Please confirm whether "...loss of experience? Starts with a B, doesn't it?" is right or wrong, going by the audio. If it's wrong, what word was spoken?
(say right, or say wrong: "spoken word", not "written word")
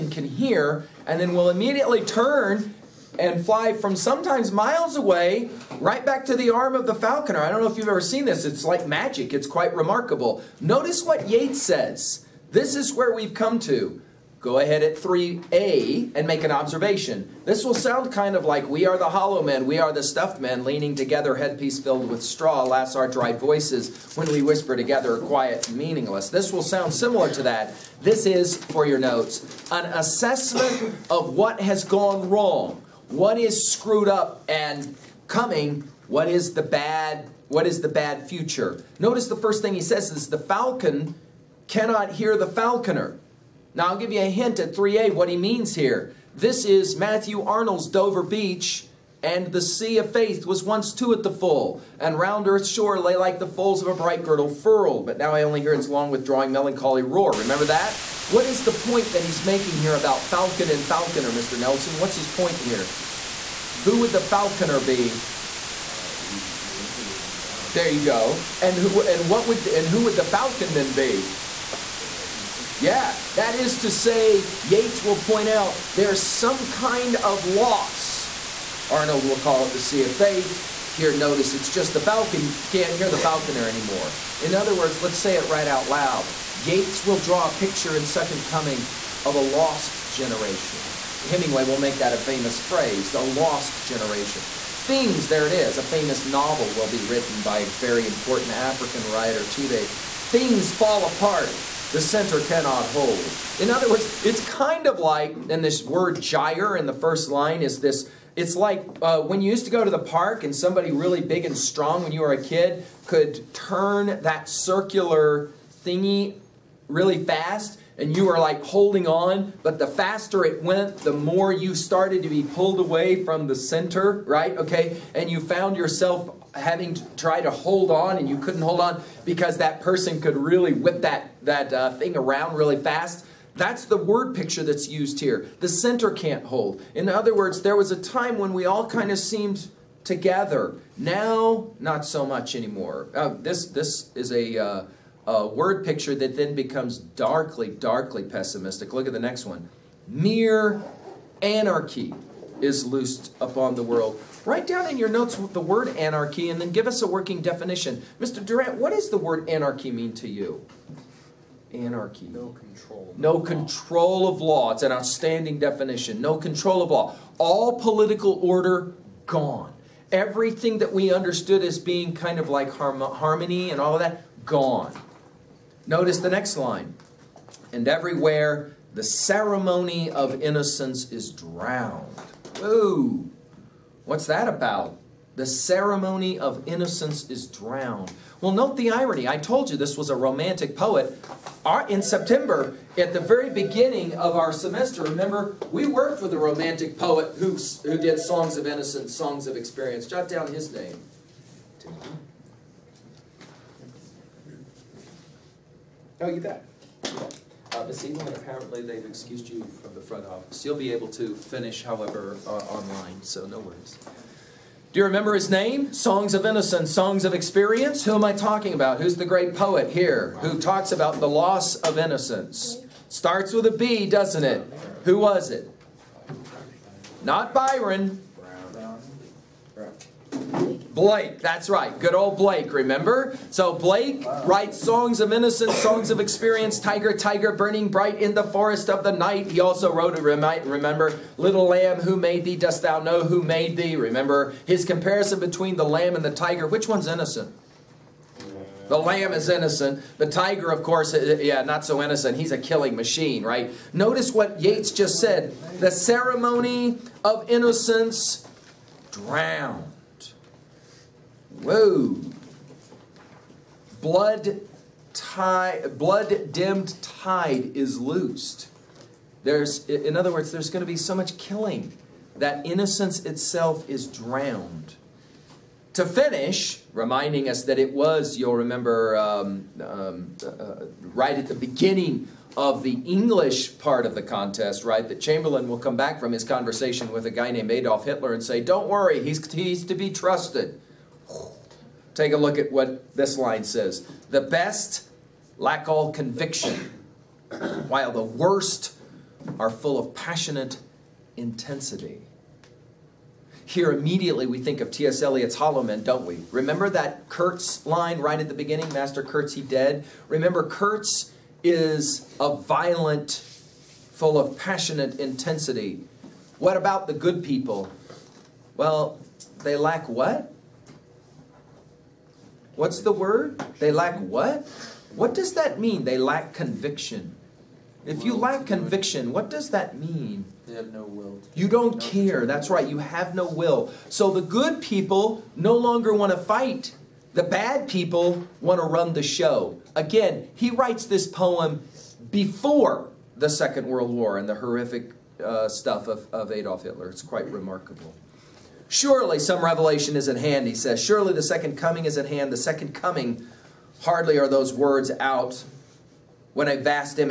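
wrong: "innocence", not "experience".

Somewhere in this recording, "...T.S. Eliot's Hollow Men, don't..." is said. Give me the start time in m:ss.
5:04.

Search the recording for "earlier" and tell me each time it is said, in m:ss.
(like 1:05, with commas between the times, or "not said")
not said.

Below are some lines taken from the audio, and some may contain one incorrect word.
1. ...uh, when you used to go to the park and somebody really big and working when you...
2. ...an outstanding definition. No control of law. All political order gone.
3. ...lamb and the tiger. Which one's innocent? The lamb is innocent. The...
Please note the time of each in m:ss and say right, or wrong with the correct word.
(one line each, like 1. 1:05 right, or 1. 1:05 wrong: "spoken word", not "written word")
1. 1:49 wrong: "strong", not "working"
2. 2:44 right
3. 4:05 right.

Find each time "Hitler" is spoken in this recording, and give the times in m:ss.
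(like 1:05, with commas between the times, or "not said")
4:48, 5:46.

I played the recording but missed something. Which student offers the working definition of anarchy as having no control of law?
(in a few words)
Mr. Durant.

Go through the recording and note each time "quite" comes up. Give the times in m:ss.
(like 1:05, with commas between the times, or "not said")
0:09, 5:47.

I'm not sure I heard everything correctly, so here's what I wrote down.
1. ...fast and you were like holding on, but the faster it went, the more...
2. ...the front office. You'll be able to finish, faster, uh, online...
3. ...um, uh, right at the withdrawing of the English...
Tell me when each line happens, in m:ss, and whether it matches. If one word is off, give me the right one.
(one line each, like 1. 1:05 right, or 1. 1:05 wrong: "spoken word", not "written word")
1. 1:57 right
2. 3:29 wrong: "however", not "faster"
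3. 4:39 wrong: "beginning", not "withdrawing".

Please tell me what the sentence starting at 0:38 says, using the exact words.
Notice the first thing he says is the falcon cannot hear the falconer.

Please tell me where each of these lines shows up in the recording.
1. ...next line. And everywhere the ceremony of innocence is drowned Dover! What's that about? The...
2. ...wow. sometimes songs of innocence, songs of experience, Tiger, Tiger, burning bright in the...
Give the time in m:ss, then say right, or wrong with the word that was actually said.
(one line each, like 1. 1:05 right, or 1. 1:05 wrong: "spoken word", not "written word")
1. 2:56 wrong: "Whoa", not "Dover"
2. 3:54 wrong: "writes", not "sometimes".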